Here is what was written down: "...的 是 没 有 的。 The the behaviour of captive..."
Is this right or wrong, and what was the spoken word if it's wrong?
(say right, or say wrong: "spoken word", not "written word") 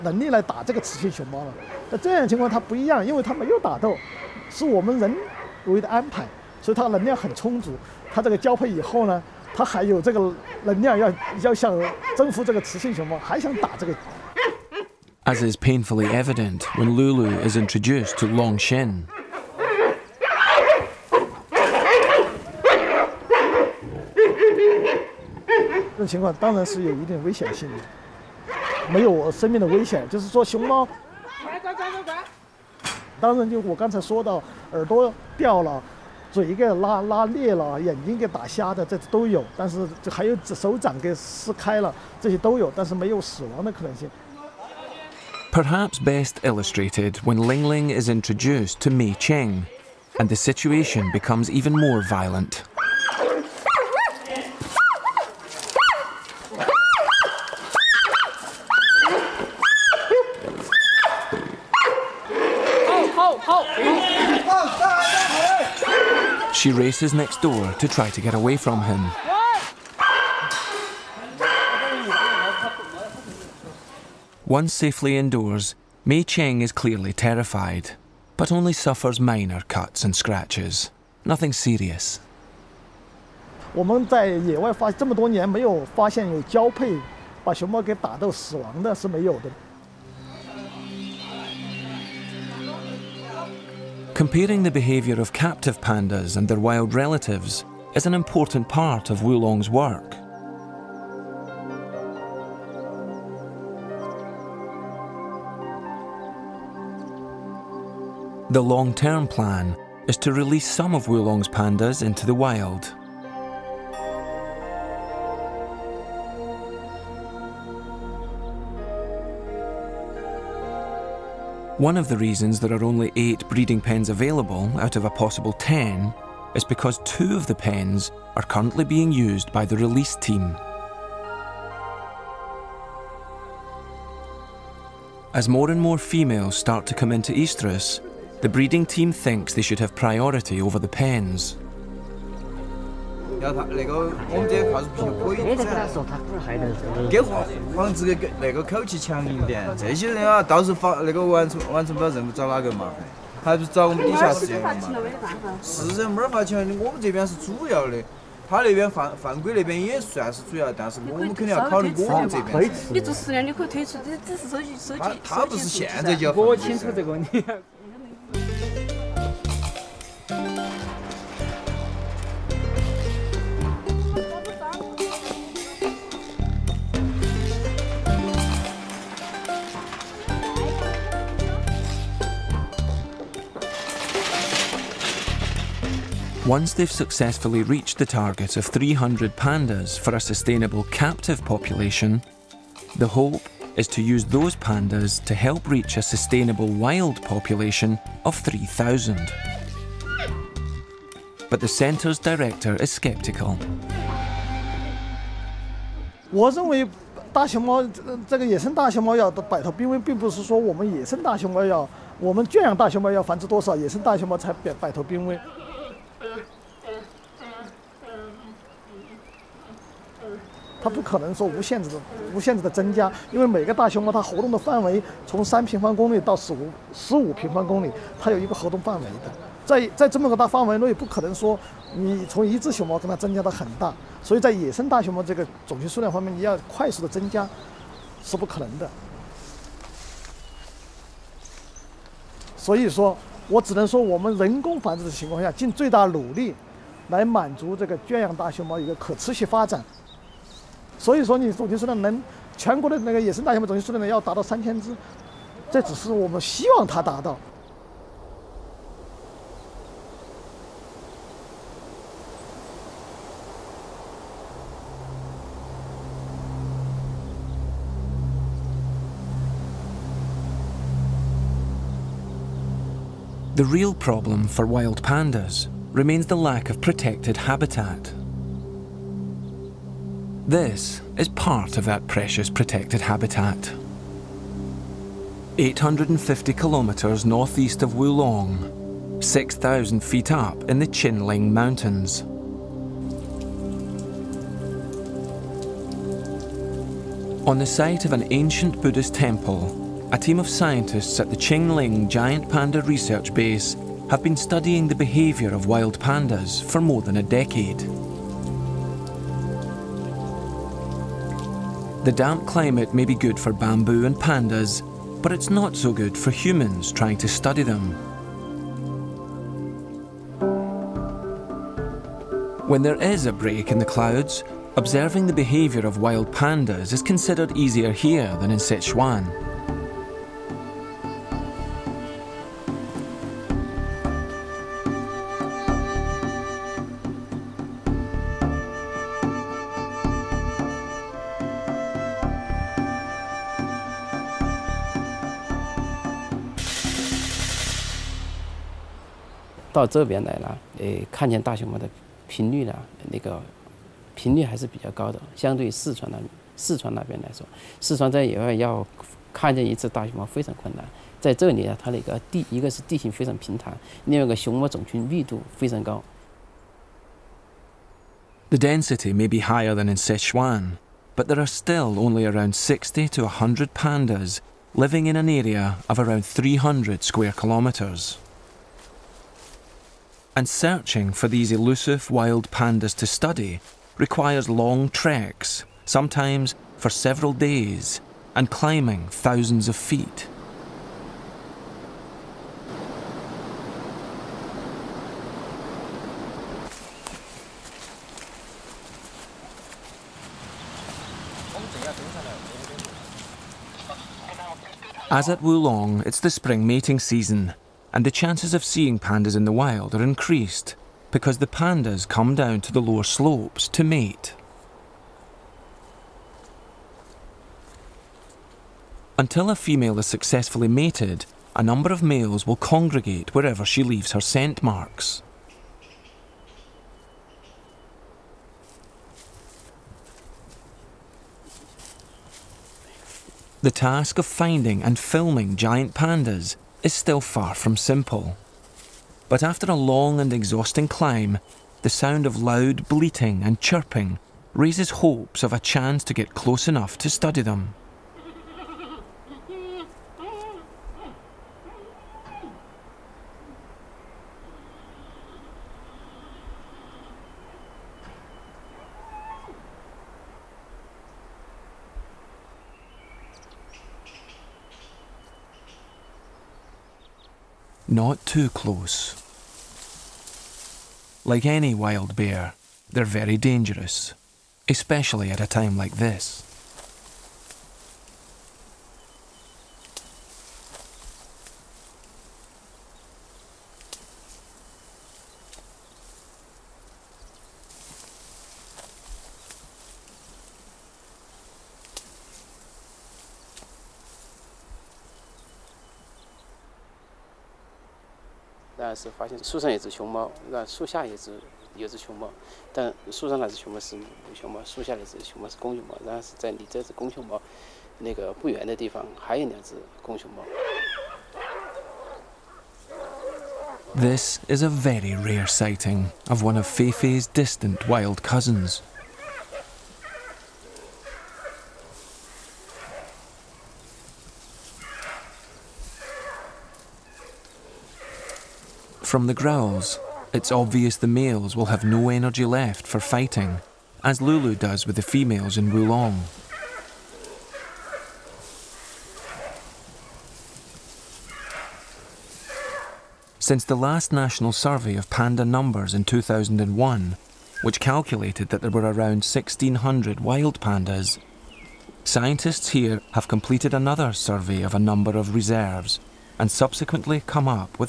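wrong: "Comparing", not "The".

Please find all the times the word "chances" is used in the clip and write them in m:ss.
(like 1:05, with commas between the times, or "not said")
6:48, 7:25.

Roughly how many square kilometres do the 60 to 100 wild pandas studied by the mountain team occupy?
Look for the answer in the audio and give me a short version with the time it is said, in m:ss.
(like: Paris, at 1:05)
300 square kilometres, at 6:16.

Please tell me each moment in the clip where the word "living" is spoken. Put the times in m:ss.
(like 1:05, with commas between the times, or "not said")
6:14.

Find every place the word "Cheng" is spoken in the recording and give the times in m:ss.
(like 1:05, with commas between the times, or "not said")
0:49, 1:16.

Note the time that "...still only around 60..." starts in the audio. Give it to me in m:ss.
6:11.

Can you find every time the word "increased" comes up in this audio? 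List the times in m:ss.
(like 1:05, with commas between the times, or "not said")
6:50.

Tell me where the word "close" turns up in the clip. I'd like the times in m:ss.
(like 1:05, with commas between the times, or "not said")
7:26, 7:48.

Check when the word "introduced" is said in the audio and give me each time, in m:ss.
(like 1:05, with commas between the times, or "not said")
0:17, 0:48.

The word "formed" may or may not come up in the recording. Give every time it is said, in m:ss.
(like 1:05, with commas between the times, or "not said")
not said.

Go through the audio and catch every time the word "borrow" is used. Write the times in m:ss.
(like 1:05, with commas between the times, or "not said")
not said.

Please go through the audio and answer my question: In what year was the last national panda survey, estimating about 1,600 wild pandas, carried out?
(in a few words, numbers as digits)
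2001.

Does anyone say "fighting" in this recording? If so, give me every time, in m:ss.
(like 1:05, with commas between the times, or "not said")
8:52.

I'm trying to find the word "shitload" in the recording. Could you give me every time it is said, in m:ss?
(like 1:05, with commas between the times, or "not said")
not said.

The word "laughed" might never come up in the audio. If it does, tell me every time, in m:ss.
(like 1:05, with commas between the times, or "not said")
not said.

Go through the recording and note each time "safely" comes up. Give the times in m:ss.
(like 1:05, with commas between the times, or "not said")
1:14.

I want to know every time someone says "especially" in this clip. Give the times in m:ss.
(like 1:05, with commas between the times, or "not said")
7:54.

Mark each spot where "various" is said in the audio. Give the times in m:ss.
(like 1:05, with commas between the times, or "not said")
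not said.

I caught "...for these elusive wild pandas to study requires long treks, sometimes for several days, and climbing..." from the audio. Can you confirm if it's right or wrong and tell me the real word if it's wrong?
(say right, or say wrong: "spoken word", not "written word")
right.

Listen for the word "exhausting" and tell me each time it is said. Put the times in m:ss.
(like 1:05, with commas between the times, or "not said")
7:20.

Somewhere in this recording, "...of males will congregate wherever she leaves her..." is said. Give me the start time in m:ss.
7:01.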